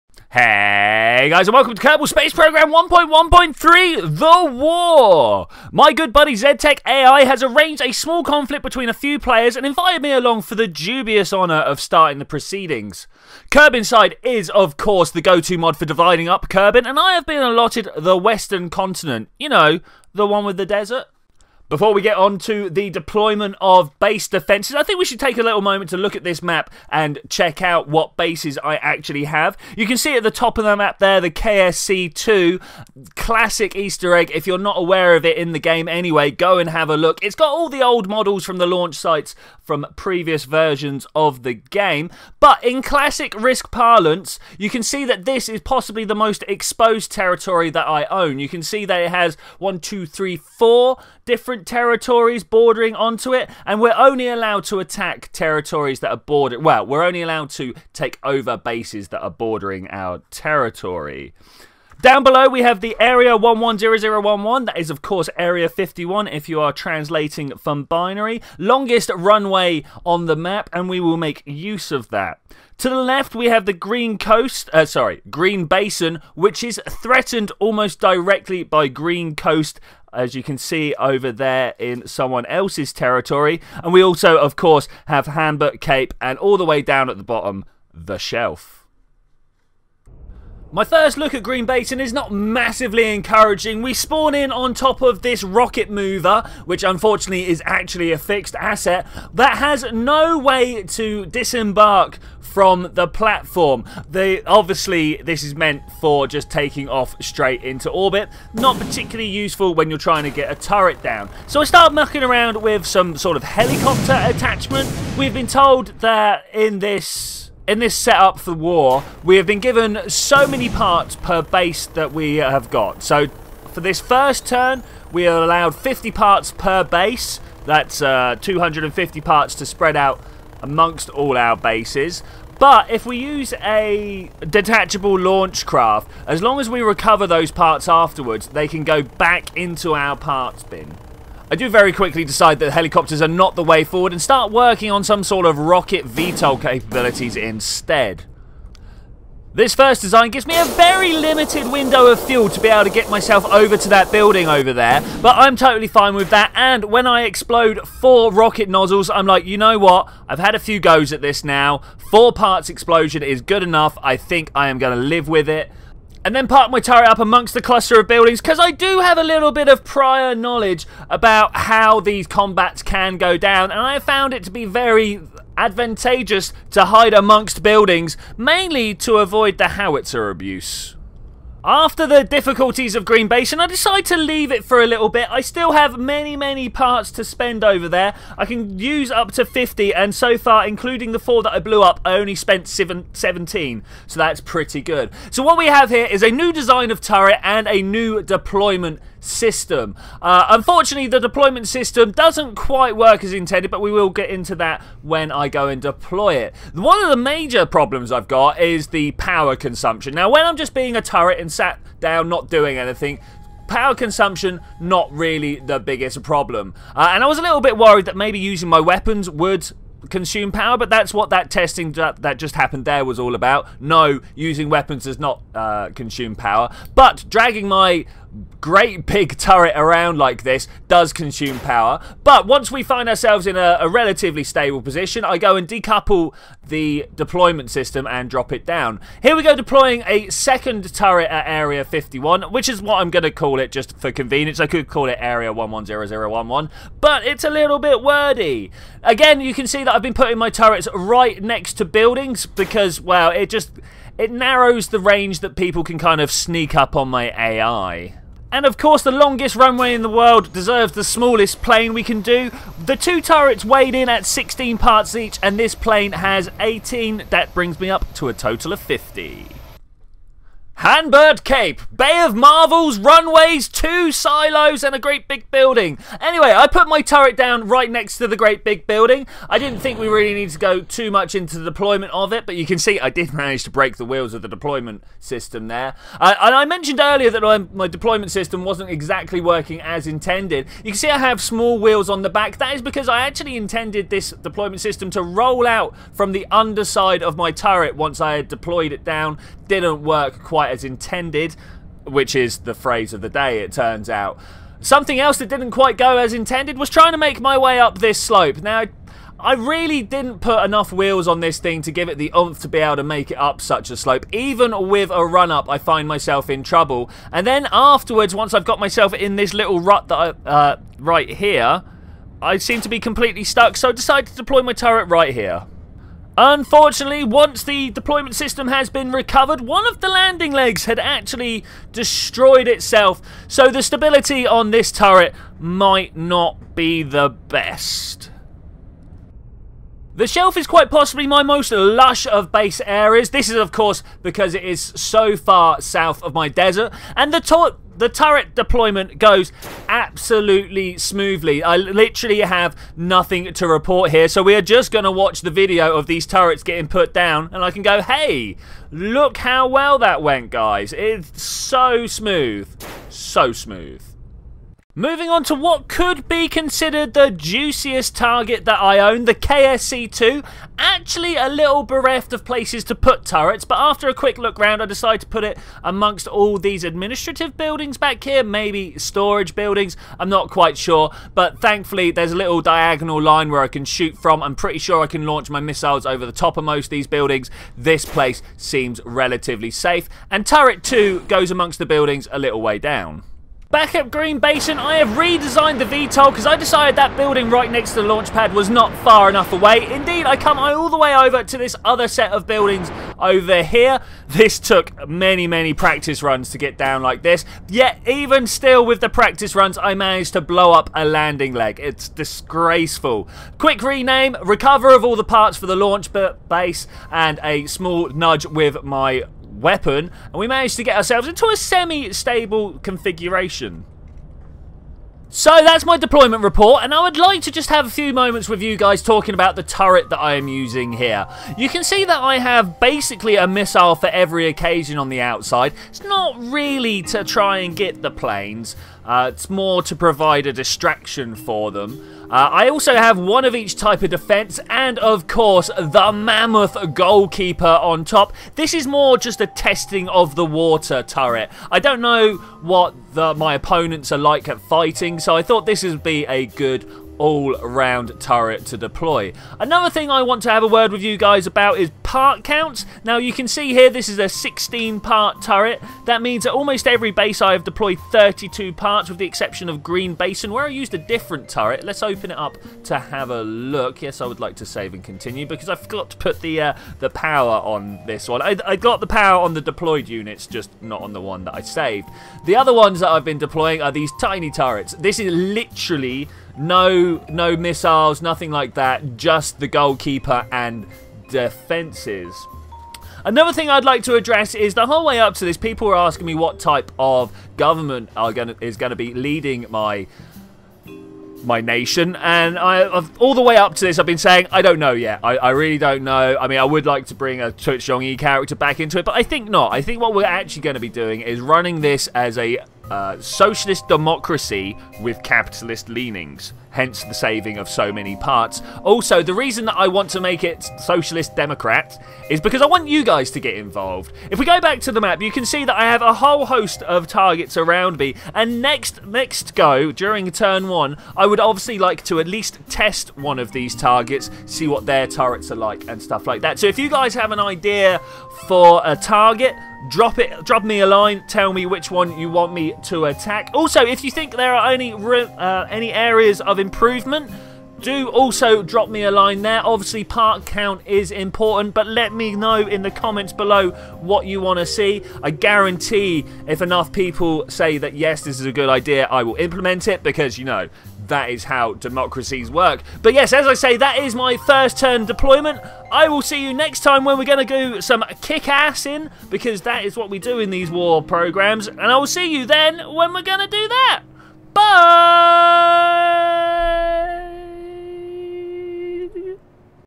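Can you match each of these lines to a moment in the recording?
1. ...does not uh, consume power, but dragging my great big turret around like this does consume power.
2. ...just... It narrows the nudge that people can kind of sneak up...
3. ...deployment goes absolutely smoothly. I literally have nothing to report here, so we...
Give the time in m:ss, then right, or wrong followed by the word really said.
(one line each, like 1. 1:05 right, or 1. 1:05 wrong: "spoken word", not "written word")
1. 3:45 right
2. 4:13 wrong: "range", not "nudge"
3. 5:48 right.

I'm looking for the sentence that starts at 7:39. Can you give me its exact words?
Another thing I want to have a word with you guys about is part counts.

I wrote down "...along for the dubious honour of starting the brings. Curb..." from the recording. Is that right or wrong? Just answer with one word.
wrong.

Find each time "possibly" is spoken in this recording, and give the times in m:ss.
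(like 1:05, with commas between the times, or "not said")
0:45, 5:40.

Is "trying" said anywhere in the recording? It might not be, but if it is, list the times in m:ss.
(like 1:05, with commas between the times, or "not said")
1:49, 5:06.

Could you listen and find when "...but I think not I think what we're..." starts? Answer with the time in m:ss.
8:29.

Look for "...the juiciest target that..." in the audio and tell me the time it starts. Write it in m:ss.
6:07.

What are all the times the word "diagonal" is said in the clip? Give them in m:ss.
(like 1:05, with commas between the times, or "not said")
6:22.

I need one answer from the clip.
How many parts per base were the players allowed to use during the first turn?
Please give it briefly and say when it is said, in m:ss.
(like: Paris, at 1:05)
50, at 2:05.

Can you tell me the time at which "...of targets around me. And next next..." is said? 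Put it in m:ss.
8:46.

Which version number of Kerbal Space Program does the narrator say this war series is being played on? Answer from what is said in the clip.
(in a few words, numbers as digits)
1.1.3.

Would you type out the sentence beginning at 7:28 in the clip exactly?
This is more just a testing of the water turret.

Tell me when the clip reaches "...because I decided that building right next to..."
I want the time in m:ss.
6:36.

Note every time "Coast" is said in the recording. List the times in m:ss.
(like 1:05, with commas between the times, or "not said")
1:14, 1:19.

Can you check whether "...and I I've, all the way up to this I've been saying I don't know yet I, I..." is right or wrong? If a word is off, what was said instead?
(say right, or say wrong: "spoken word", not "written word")
right.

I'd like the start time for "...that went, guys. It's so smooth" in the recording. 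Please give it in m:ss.
5:59.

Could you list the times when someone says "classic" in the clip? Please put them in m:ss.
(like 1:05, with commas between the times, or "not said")
0:33, 0:42.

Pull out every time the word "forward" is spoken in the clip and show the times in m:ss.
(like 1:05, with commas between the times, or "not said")
2:23.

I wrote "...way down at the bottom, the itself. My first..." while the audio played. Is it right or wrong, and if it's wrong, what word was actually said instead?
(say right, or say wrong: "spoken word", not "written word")
wrong: "shelf", not "itself".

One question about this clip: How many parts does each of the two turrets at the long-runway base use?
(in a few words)
16.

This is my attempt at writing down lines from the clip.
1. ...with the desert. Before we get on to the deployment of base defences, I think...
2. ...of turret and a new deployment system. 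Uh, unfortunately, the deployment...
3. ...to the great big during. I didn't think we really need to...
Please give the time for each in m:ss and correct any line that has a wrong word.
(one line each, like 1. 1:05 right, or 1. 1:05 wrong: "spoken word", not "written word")
1. 0:20 right
2. 3:16 right
3. 4:38 wrong: "building", not "during".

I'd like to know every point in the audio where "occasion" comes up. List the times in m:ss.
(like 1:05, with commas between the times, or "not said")
7:14.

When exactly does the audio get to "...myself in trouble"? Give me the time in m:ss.
5:16.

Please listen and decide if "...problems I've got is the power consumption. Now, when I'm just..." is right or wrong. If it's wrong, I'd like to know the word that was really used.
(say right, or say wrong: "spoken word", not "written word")
right.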